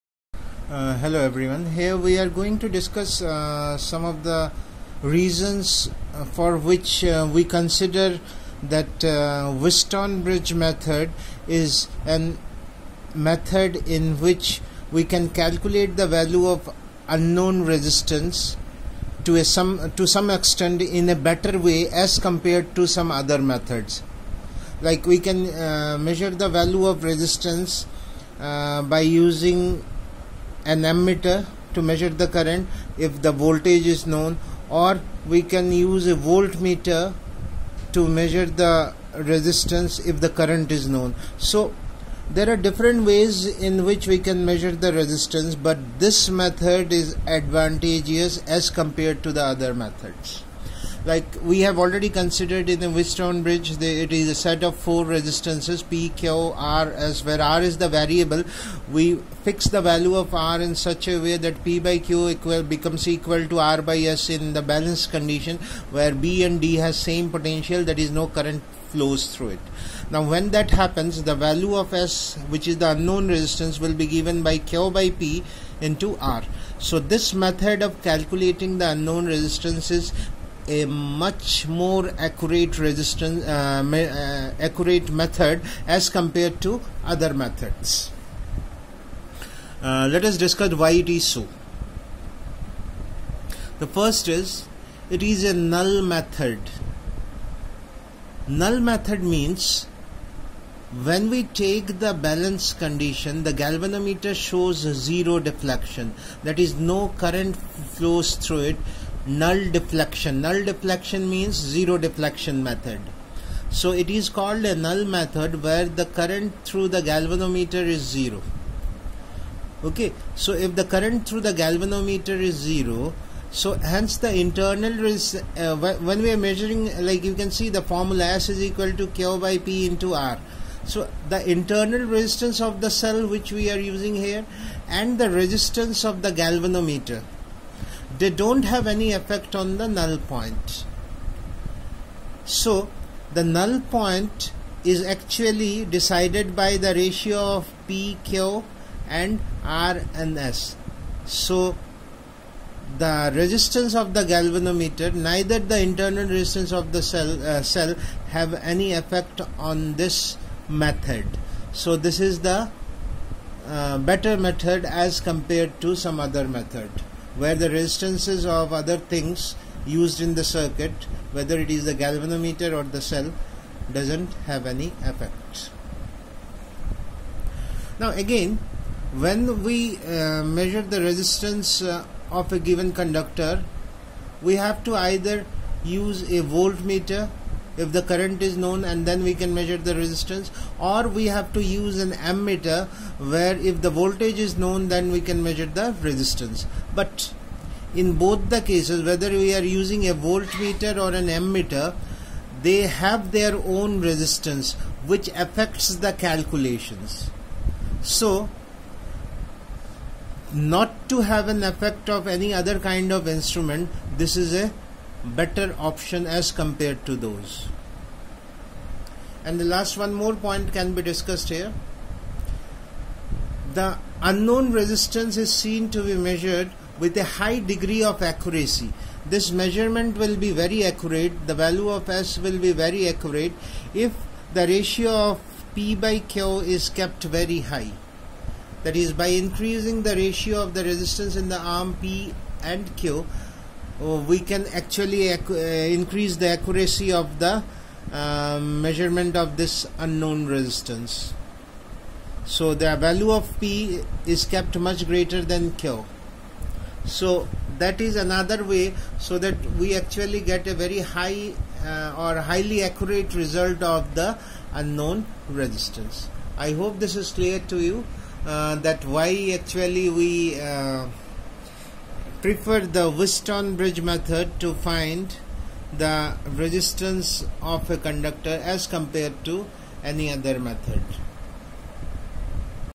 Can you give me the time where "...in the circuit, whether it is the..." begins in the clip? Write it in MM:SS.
02:50.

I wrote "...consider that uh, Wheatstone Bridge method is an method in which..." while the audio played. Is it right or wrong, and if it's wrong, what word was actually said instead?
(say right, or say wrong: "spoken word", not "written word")
right.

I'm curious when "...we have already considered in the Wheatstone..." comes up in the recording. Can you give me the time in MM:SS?
00:51.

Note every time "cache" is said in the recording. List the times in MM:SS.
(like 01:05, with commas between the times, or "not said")
not said.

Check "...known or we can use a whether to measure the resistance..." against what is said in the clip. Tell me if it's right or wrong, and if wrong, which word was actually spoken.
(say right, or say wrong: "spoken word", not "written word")
wrong: "voltmeter", not "whether".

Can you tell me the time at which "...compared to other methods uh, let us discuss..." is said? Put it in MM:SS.
01:26.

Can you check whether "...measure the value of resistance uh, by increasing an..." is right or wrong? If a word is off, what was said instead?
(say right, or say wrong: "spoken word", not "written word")
wrong: "using", not "increasing".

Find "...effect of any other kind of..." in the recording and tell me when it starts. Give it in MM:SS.
03:31.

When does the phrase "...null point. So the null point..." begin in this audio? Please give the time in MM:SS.
02:19.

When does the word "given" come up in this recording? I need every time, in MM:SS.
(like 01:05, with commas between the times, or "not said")
01:14, 03:02.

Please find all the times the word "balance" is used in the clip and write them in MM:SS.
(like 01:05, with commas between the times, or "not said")
01:04, 01:42.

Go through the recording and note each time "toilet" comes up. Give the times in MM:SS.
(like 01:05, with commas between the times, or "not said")
not said.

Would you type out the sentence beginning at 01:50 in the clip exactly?
Null deflection means zero deflection method.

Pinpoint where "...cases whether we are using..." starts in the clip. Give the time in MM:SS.
03:18.